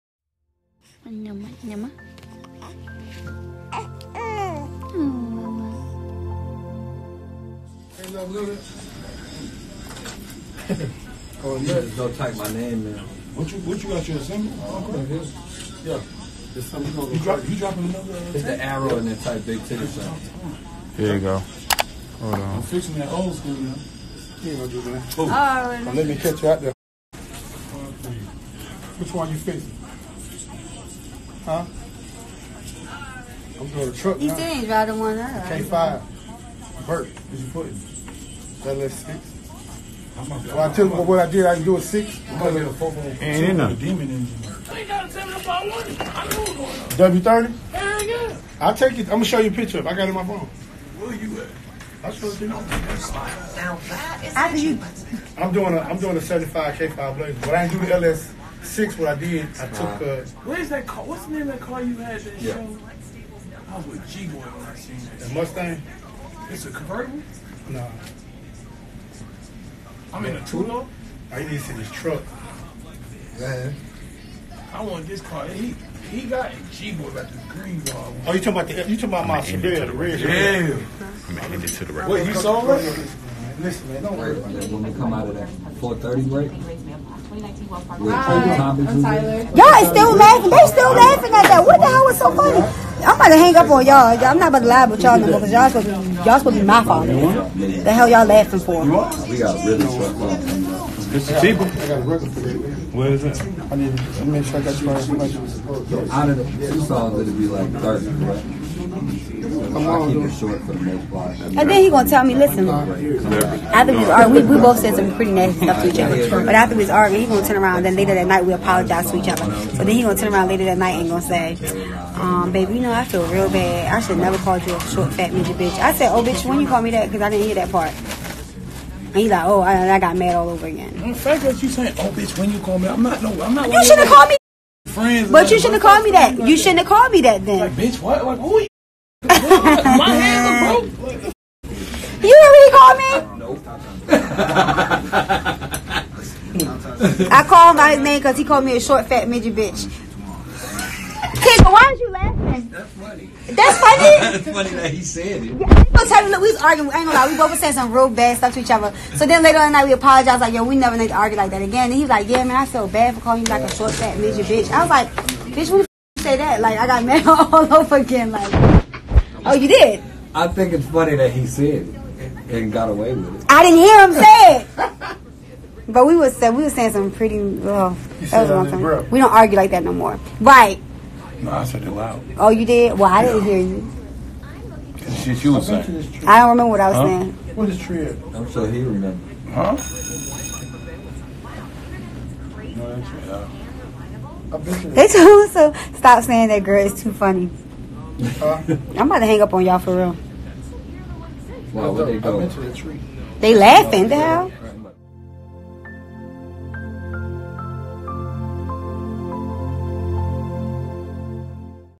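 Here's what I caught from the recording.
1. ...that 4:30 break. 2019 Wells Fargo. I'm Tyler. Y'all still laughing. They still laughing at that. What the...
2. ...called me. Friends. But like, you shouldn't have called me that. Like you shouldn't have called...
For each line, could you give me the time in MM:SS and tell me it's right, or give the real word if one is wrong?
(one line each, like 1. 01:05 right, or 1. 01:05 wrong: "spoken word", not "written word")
1. 01:25 right
2. 02:14 right.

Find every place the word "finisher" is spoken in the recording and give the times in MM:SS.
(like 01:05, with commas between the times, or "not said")
not said.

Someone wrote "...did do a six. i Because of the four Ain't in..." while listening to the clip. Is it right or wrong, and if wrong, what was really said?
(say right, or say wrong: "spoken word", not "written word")
right.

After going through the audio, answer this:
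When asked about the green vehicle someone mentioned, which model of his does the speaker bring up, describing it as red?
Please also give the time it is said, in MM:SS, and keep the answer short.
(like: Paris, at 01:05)
Sierra, at 01:19.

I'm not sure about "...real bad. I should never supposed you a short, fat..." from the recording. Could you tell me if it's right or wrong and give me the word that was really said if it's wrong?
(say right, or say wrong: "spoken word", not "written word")
wrong: "called", not "supposed".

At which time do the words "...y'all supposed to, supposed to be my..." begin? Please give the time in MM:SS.
01:35.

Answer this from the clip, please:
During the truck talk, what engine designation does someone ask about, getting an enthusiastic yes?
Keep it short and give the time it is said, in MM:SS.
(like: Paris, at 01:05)
W30, at 00:47.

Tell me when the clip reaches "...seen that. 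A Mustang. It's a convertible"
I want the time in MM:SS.
01:04.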